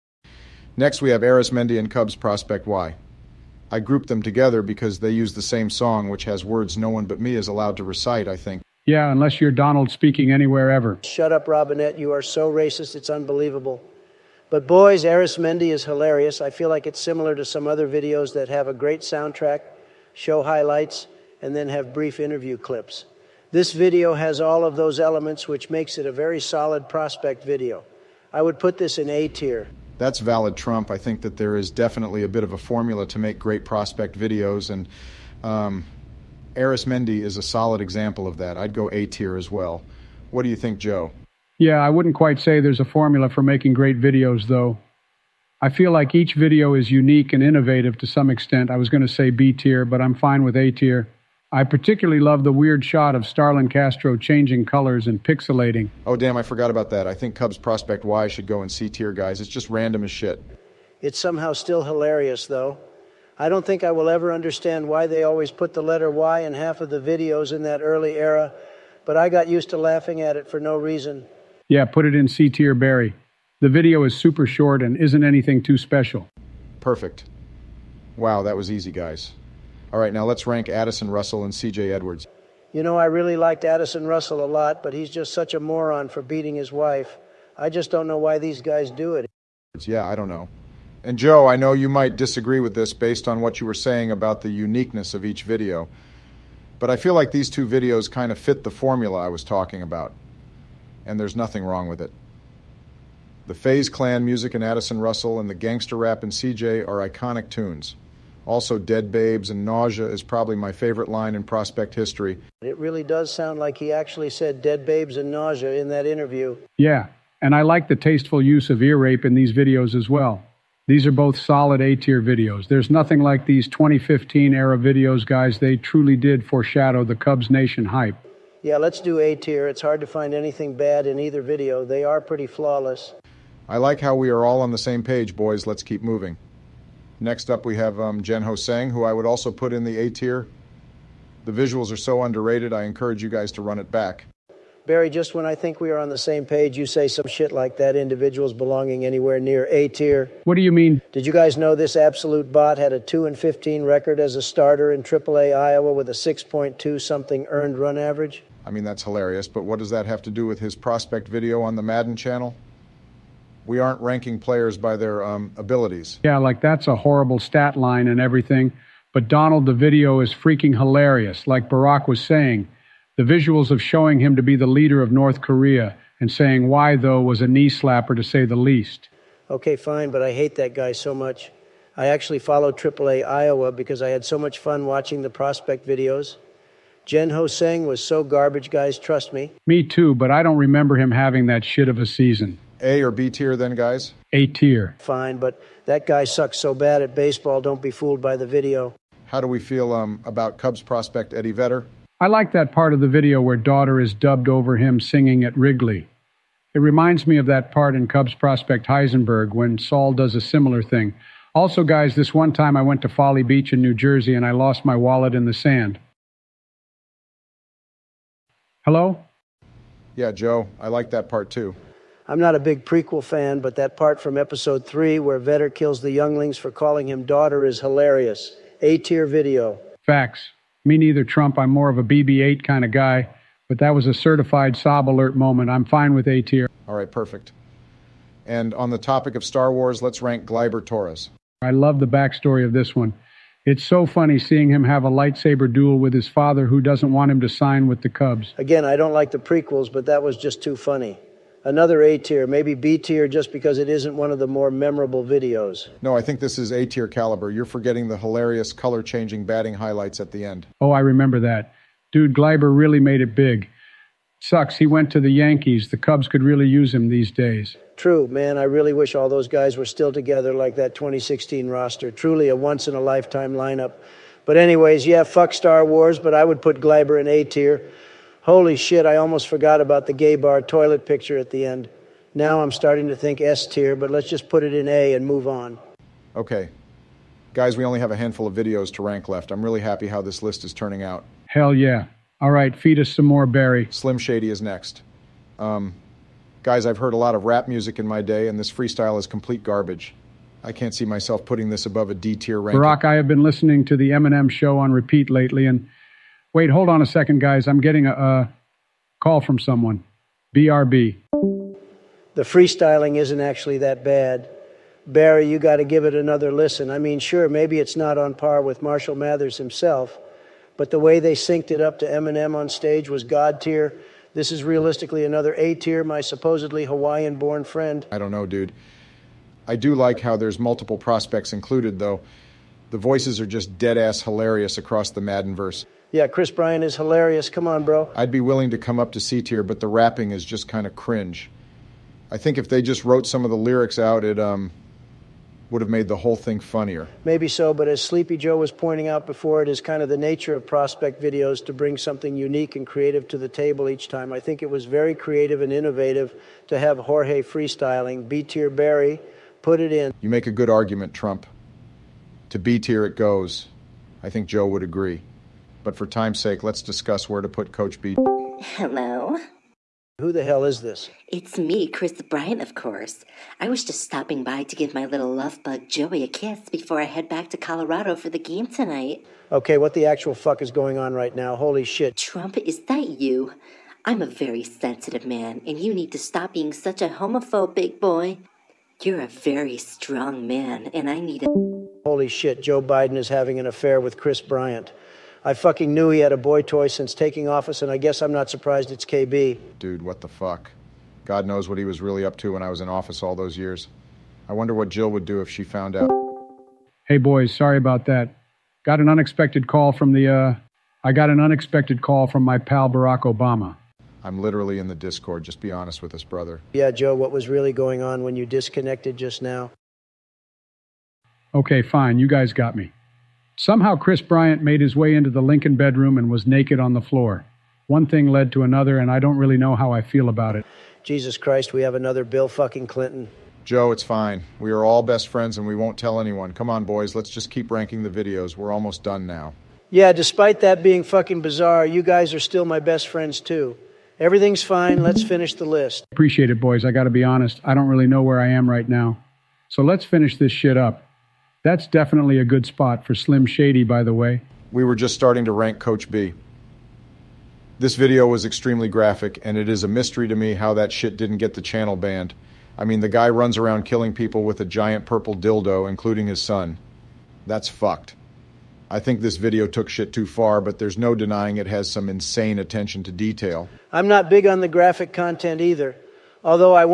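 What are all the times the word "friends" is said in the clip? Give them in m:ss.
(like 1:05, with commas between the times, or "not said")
5:27, 7:15, 7:23.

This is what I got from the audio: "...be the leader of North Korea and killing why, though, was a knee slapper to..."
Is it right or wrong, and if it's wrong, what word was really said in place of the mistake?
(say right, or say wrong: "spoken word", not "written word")
wrong: "saying", not "killing".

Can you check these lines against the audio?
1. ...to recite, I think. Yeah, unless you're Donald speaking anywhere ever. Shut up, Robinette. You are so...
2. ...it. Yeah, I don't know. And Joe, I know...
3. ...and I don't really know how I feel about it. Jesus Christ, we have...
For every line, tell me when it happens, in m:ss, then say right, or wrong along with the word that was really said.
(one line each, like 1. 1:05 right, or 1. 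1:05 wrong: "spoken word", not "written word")
1. 0:07 right
2. 1:29 right
3. 7:08 right.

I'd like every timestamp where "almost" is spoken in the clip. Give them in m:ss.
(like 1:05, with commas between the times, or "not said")
4:39, 7:18.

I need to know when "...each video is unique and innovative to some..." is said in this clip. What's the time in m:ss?
0:46.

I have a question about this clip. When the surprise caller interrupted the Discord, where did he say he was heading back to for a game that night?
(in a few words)
Colorado.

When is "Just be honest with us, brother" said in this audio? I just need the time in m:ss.
6:55.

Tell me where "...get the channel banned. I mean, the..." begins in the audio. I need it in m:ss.
7:41.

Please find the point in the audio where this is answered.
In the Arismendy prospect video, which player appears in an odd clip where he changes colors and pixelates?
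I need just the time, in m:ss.
0:53.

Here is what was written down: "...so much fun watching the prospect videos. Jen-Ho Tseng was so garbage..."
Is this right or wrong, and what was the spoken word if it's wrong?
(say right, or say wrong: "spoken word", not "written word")
right.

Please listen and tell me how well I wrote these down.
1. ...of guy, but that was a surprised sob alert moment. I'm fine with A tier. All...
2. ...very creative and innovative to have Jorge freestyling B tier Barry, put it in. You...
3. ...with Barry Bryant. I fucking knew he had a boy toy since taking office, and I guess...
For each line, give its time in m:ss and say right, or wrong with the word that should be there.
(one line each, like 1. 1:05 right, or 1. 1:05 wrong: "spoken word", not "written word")
1. 3:52 wrong: "certified", not "surprised"
2. 5:54 right
3. 6:34 wrong: "Kris", not "Barry".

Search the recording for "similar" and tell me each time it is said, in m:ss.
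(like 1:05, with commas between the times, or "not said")
0:17, 3:30.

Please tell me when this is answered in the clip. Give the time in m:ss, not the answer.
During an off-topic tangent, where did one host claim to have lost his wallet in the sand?
3:33.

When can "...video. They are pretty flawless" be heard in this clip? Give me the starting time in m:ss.
2:11.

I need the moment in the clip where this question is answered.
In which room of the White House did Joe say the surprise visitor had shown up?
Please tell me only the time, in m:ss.
7:05.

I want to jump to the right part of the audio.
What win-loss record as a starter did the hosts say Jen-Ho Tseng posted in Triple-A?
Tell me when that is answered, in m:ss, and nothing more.
2:33.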